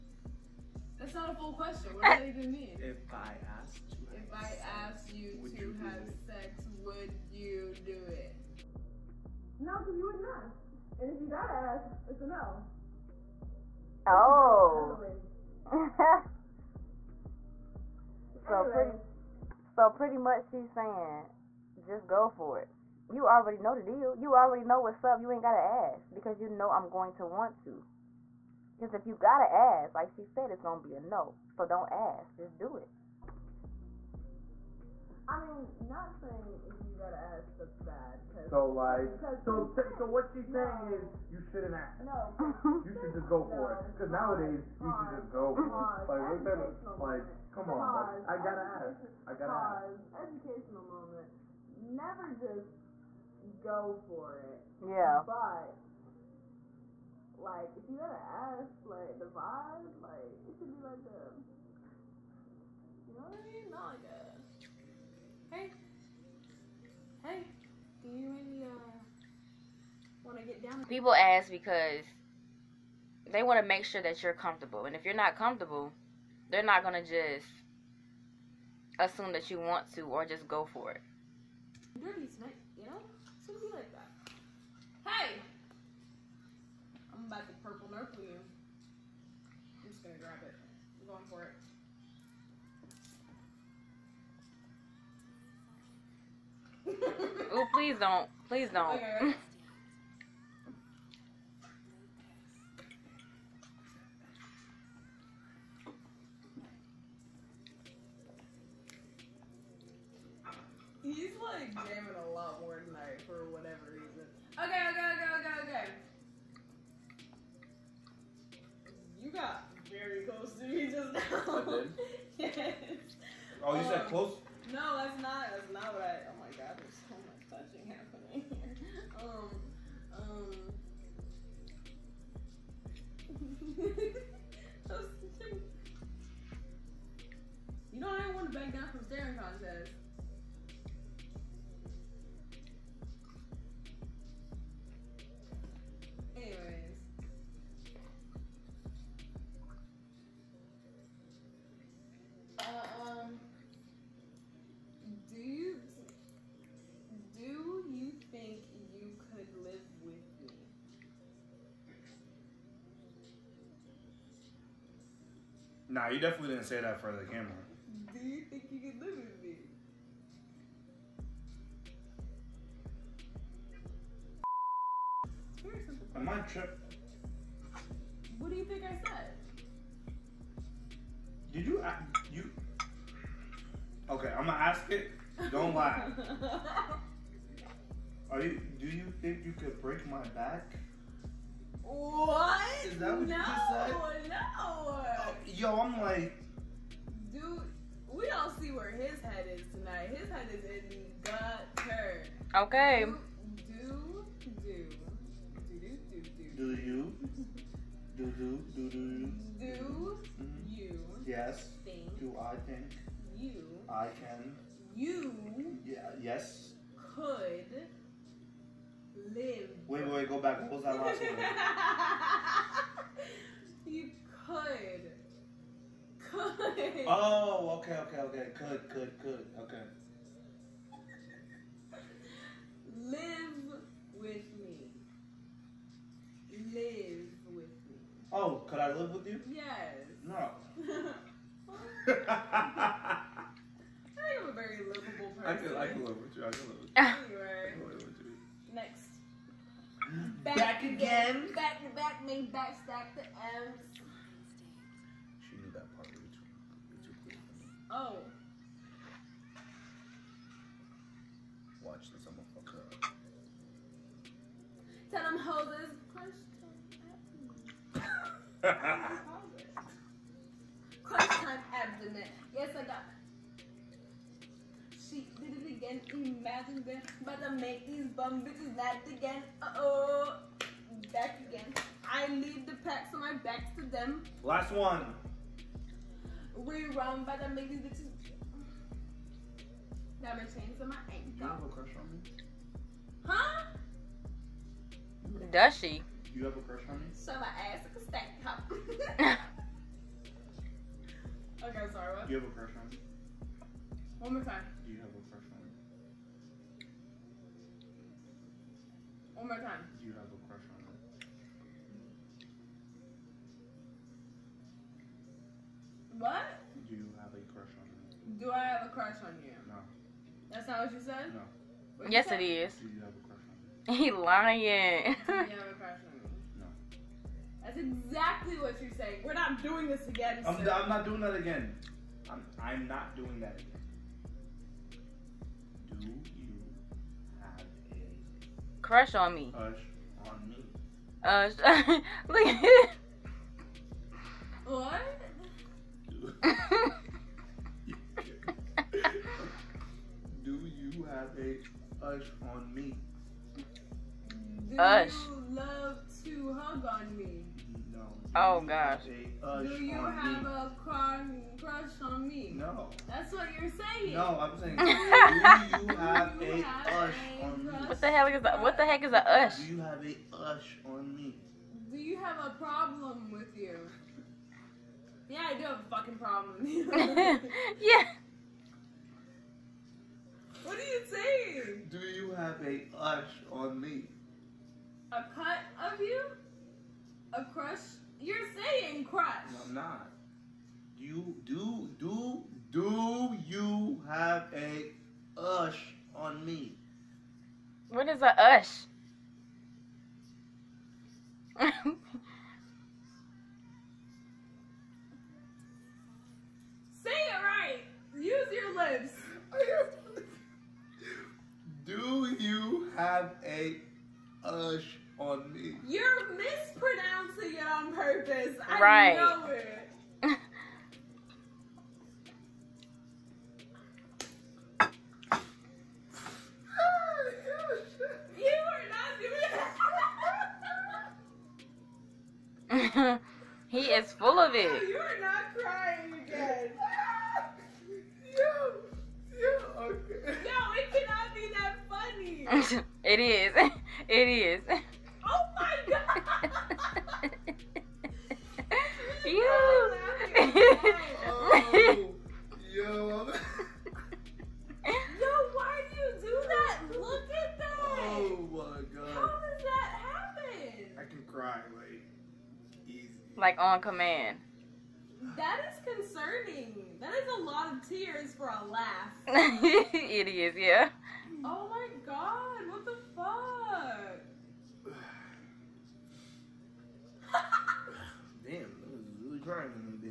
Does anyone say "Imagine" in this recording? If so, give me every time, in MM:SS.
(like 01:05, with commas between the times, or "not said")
04:36.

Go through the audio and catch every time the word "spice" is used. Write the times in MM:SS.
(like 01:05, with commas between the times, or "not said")
not said.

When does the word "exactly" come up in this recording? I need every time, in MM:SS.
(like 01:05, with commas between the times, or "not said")
05:27.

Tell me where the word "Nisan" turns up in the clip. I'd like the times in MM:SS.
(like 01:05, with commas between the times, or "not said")
not said.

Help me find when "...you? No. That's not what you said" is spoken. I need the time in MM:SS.
05:19.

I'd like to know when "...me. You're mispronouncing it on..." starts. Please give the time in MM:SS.
06:55.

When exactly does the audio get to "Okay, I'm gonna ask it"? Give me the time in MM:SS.
03:04.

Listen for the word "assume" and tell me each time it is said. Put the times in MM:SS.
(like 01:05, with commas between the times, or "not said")
01:18.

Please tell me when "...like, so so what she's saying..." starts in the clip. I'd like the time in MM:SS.
00:38.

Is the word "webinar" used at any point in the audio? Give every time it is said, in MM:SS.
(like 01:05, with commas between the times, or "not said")
not said.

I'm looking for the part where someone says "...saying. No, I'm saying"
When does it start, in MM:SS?
06:03.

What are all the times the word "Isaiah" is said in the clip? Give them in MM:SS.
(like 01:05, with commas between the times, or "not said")
not said.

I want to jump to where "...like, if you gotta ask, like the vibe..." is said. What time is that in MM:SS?
00:57.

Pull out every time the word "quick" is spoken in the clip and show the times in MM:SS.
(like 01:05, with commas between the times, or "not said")
04:17.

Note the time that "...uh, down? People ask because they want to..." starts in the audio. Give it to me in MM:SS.
01:07.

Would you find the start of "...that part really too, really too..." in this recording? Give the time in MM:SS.
04:15.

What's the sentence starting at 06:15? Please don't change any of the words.
Yeah, I do have a fucking problem with you.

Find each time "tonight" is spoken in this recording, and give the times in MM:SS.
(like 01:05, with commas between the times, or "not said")
01:22, 03:19.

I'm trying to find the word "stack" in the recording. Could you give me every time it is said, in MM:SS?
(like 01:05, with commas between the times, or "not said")
04:12, 04:58.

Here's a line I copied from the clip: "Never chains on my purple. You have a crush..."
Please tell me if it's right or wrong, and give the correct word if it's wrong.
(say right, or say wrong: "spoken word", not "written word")
wrong: "ankle", not "purple".